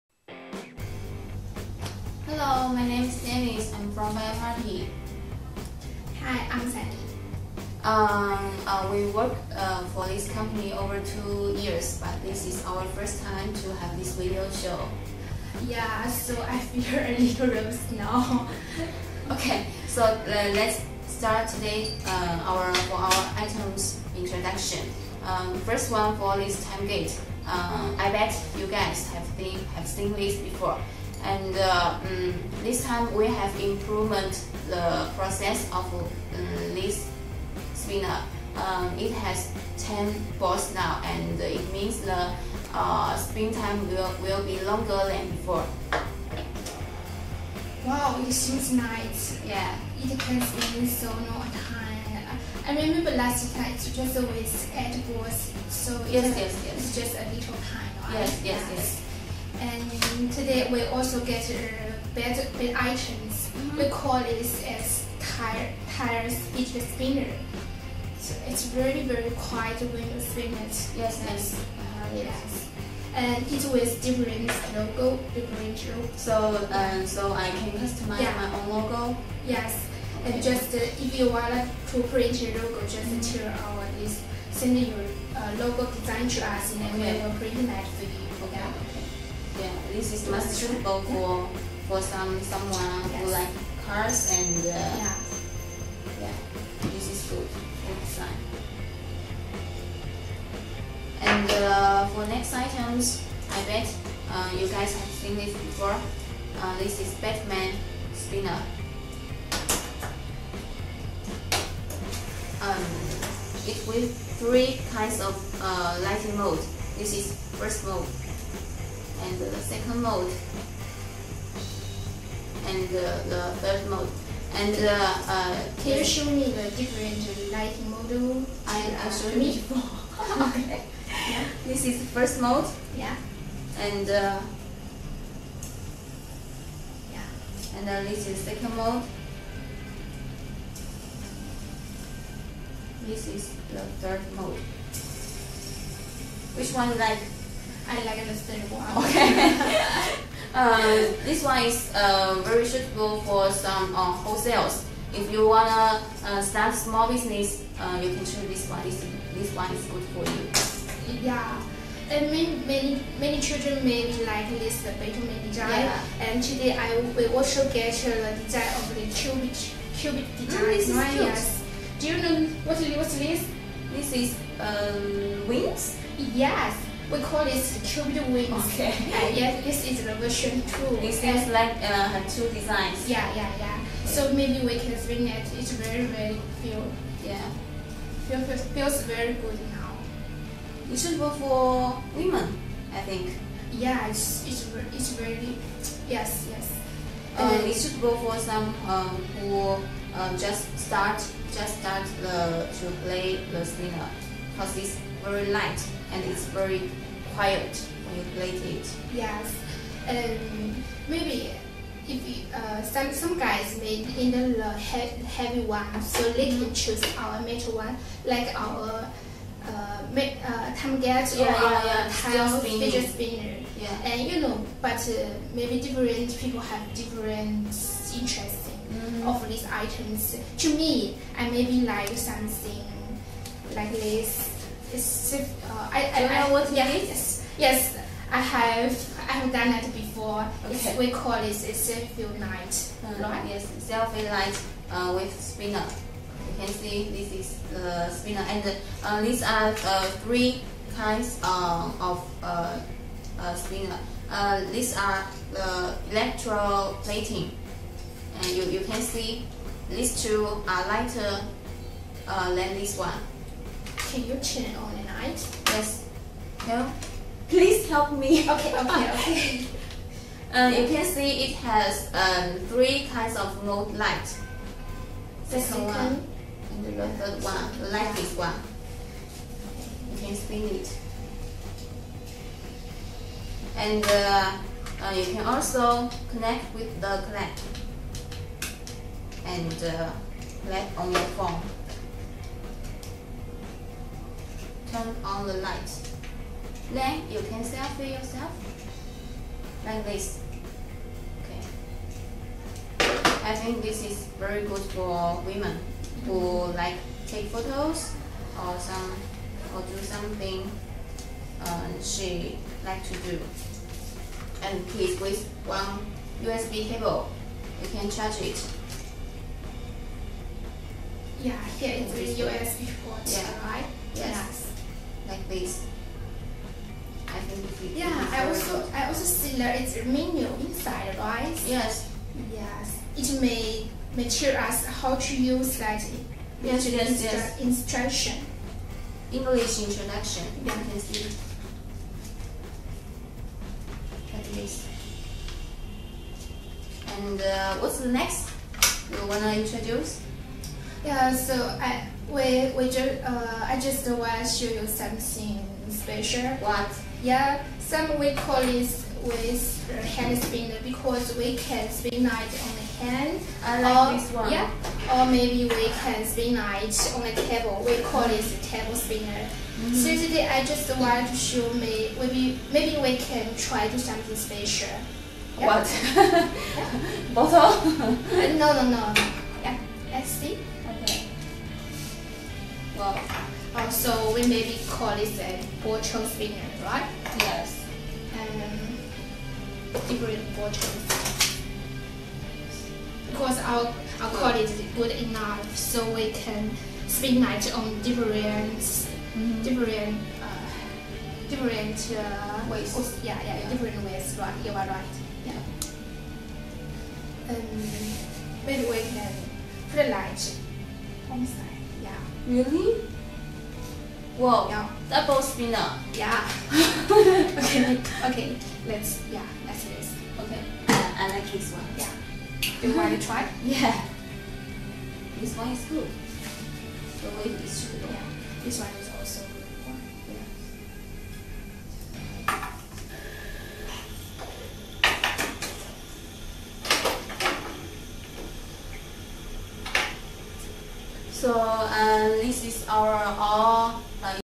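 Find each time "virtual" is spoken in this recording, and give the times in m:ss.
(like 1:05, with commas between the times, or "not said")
6:25, 6:30.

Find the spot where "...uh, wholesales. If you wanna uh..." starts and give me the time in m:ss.
2:33.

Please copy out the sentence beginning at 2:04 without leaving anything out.
And can uh, uh, you show me the different lighting model?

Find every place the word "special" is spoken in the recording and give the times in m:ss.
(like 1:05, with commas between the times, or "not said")
5:55, 6:14.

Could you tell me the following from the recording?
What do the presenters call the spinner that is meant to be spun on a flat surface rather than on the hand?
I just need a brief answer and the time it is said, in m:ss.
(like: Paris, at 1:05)
Table spinner, at 6:08.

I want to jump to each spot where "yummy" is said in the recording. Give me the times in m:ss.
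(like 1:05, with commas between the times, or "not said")
not said.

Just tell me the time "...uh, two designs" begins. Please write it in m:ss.
3:01.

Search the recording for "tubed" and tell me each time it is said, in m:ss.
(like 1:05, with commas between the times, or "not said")
2:57.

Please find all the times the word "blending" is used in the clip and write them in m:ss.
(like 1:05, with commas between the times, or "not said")
not said.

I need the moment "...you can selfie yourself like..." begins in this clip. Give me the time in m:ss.
4:57.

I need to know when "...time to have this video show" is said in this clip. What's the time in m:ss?
0:13.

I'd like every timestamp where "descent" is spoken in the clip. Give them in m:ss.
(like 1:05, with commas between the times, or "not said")
not said.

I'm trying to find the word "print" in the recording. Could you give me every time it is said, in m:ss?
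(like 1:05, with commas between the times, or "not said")
1:22, 1:27.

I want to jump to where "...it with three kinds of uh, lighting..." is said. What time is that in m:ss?
1:53.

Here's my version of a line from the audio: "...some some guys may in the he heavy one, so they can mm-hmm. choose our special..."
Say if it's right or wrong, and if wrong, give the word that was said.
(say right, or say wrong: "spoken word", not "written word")
wrong: "metal", not "special".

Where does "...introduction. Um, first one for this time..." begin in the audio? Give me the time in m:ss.
0:24.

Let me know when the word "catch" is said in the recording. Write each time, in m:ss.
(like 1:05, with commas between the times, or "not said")
not said.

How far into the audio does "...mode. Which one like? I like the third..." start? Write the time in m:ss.
2:24.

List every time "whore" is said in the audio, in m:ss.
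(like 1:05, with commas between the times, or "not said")
not said.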